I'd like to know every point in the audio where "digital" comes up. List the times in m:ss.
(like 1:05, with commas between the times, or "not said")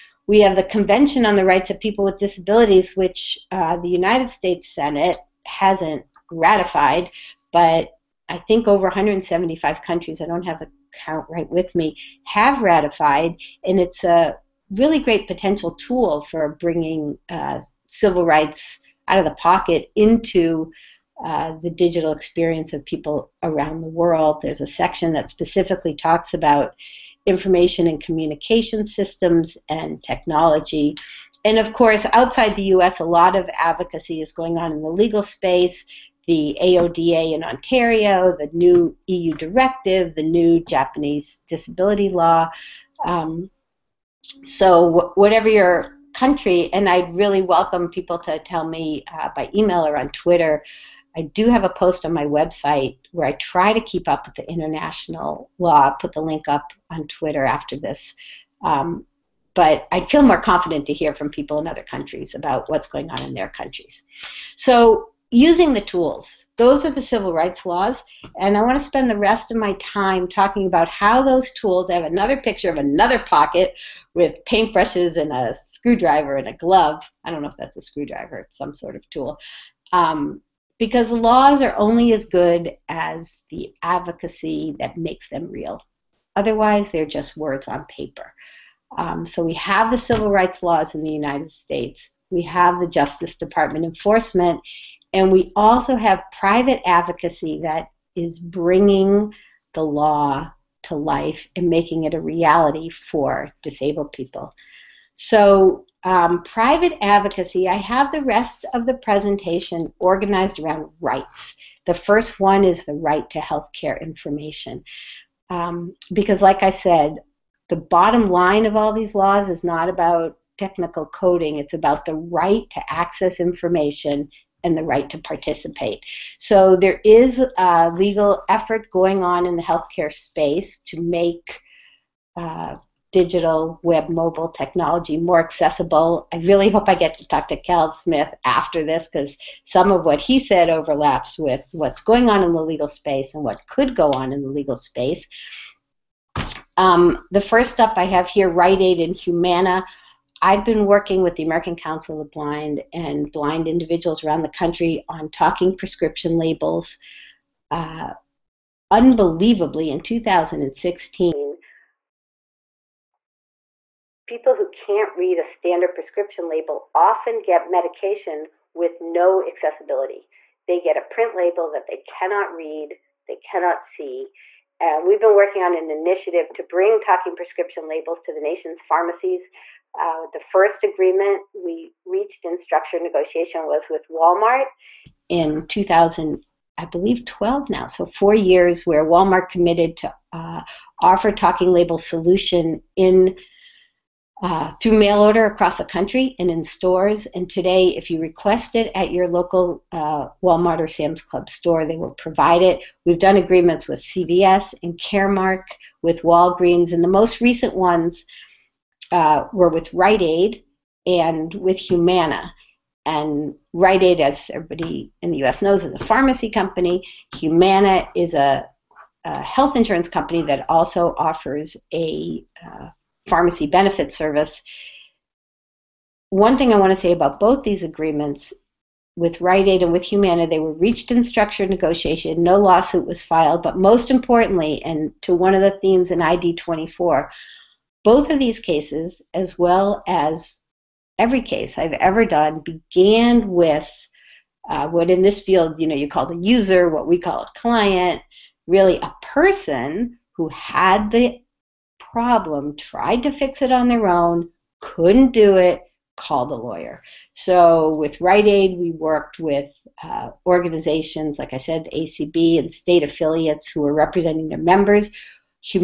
0:21, 2:13.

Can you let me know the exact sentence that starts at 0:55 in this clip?
I'll put the link up on Twitter after this.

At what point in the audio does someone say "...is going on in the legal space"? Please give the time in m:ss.
0:34.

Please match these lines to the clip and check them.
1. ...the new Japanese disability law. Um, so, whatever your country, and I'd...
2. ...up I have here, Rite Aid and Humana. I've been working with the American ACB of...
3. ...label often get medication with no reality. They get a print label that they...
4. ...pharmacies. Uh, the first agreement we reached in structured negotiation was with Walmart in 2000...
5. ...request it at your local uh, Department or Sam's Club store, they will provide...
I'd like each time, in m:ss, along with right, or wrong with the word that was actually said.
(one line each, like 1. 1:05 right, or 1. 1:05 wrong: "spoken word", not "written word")
1. 0:40 right
2. 2:27 wrong: "Council", not "ACB"
3. 2:46 wrong: "accessibility", not "reality"
4. 2:58 right
5. 3:18 wrong: "Walmart", not "Department".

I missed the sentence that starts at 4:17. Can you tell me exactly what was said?
So with Rite Aid, we worked with uh, organizations, like I said, ACB and state affiliates who were representing their members.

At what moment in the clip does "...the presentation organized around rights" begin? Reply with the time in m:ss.
1:48.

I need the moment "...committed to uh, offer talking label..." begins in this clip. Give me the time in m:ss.
3:09.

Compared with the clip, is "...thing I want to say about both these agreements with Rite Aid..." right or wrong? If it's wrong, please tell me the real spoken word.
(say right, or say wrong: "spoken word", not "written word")
right.